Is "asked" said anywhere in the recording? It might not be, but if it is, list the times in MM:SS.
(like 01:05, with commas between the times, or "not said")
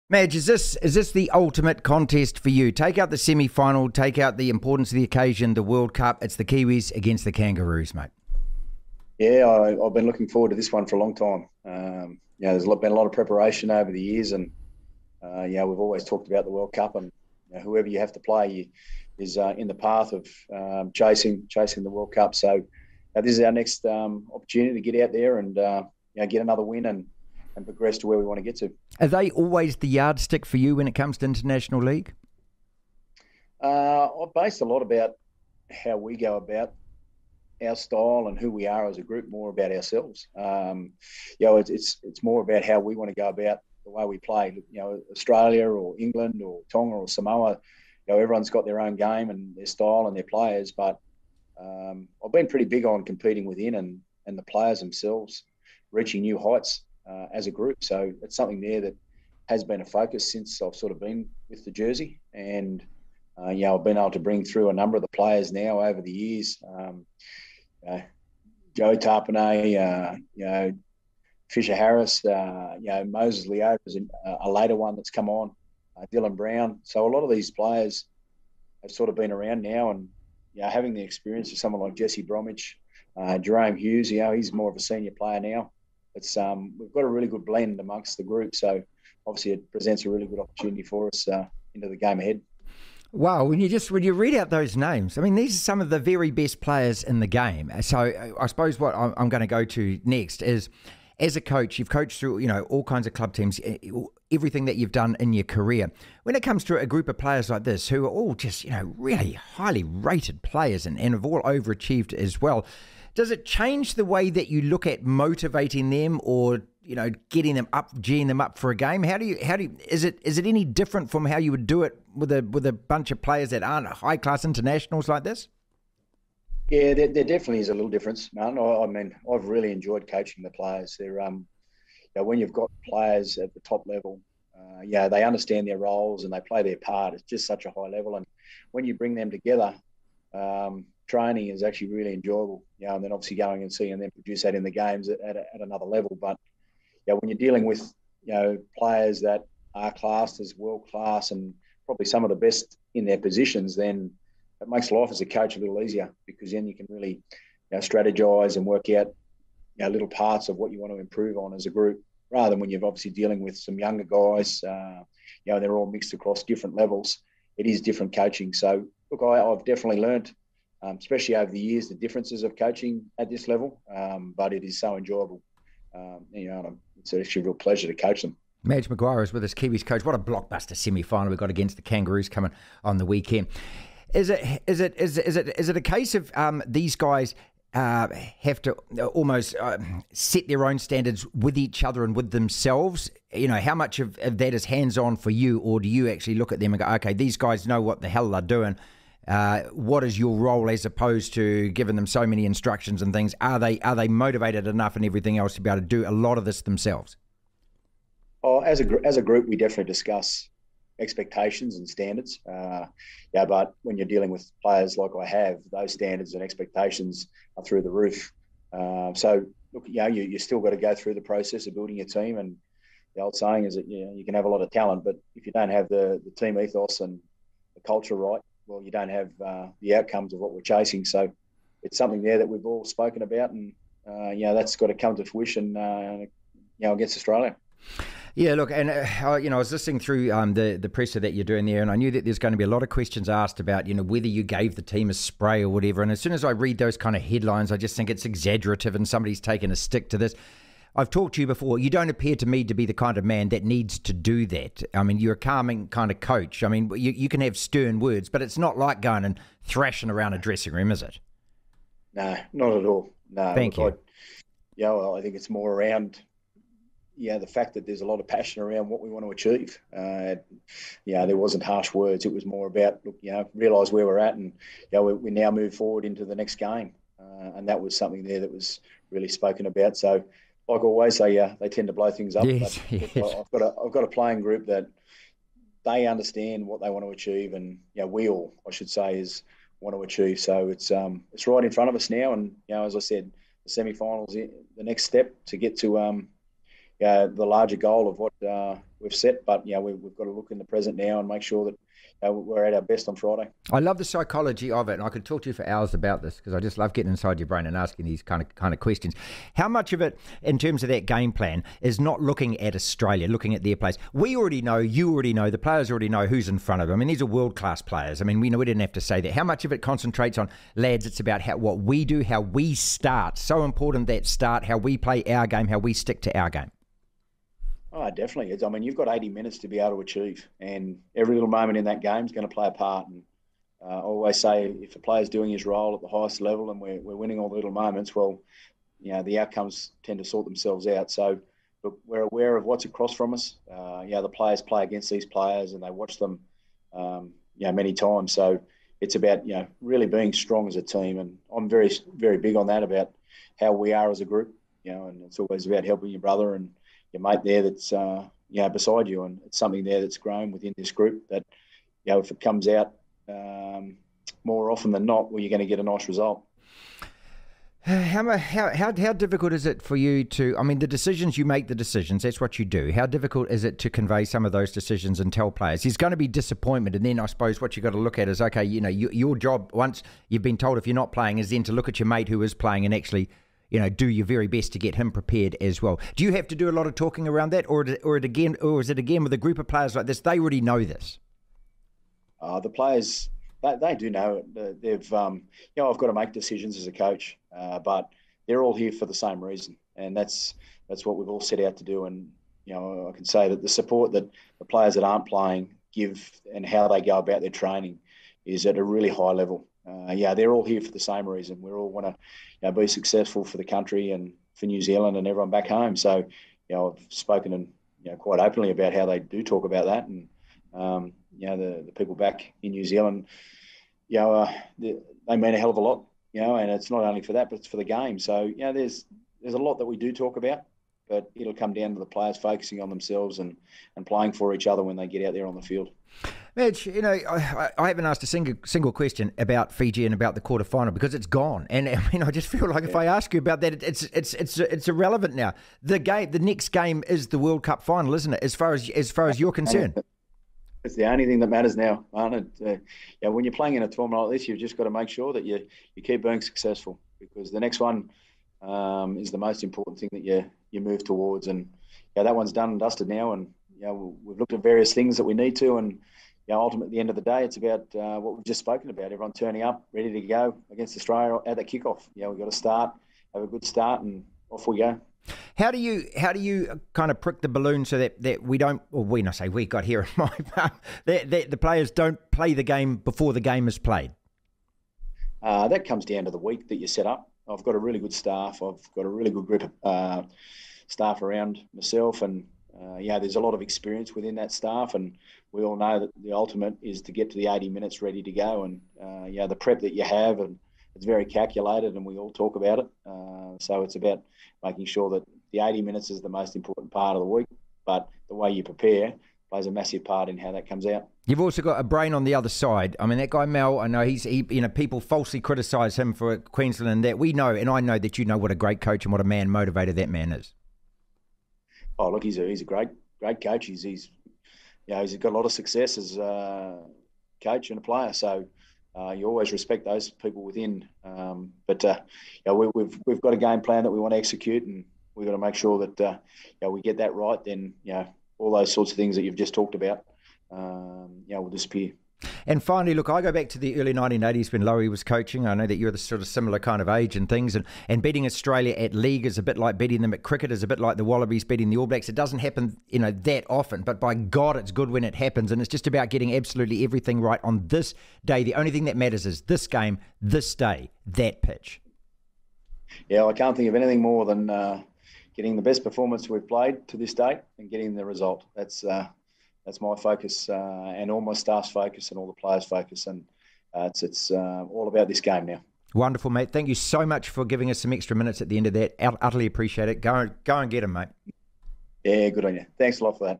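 04:03, 07:18.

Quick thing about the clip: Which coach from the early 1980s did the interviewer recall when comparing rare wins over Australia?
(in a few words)
Lowry.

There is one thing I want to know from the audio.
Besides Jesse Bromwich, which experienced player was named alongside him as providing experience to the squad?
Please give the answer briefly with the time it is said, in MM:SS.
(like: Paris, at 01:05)
Jahrome Hughes, at 01:23.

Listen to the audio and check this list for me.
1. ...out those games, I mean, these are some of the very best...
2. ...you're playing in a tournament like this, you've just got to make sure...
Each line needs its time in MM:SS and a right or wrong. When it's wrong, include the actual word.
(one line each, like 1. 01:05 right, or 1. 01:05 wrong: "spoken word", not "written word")
1. 01:34 wrong: "names", not "games"
2. 07:33 right.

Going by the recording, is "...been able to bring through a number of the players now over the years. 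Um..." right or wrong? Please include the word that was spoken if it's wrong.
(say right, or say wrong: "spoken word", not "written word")
right.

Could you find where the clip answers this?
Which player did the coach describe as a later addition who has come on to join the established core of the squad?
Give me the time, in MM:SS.
01:13.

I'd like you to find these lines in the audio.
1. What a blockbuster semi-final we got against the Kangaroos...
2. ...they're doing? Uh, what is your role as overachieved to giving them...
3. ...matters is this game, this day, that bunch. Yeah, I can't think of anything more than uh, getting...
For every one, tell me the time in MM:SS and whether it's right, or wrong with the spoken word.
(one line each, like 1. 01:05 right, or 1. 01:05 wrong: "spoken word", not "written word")
1. 03:00 right
2. 03:18 wrong: "opposed", not "overachieved"
3. 09:18 wrong: "pitch", not "bunch".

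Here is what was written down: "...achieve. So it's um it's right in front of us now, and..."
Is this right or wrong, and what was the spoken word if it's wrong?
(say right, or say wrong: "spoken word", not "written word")
right.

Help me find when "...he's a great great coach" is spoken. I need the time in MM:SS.
08:42.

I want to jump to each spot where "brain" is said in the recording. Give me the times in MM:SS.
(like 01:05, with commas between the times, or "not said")
05:07, 08:31.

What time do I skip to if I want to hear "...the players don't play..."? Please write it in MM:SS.
08:01.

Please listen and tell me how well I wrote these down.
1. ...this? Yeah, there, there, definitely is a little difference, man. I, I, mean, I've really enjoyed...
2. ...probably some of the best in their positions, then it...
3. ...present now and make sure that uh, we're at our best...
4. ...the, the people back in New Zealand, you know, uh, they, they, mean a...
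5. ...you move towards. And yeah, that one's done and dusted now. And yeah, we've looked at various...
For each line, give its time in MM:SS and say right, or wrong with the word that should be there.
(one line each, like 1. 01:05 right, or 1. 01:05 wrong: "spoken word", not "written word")
1. 02:05 right
2. 02:31 right
3. 05:00 right
4. 07:01 right
5. 07:40 right.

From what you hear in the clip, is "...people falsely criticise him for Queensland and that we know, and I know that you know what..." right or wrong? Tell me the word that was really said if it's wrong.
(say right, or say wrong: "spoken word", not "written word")
right.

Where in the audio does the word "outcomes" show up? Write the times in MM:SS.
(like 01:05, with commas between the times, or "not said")
03:49, 05:39.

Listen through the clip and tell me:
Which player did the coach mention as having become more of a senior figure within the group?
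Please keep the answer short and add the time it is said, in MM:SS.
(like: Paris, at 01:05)
Jahrome Hughes, at 01:23.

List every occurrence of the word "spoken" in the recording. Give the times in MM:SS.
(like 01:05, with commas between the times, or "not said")
03:52, 04:39, 06:57, 07:48.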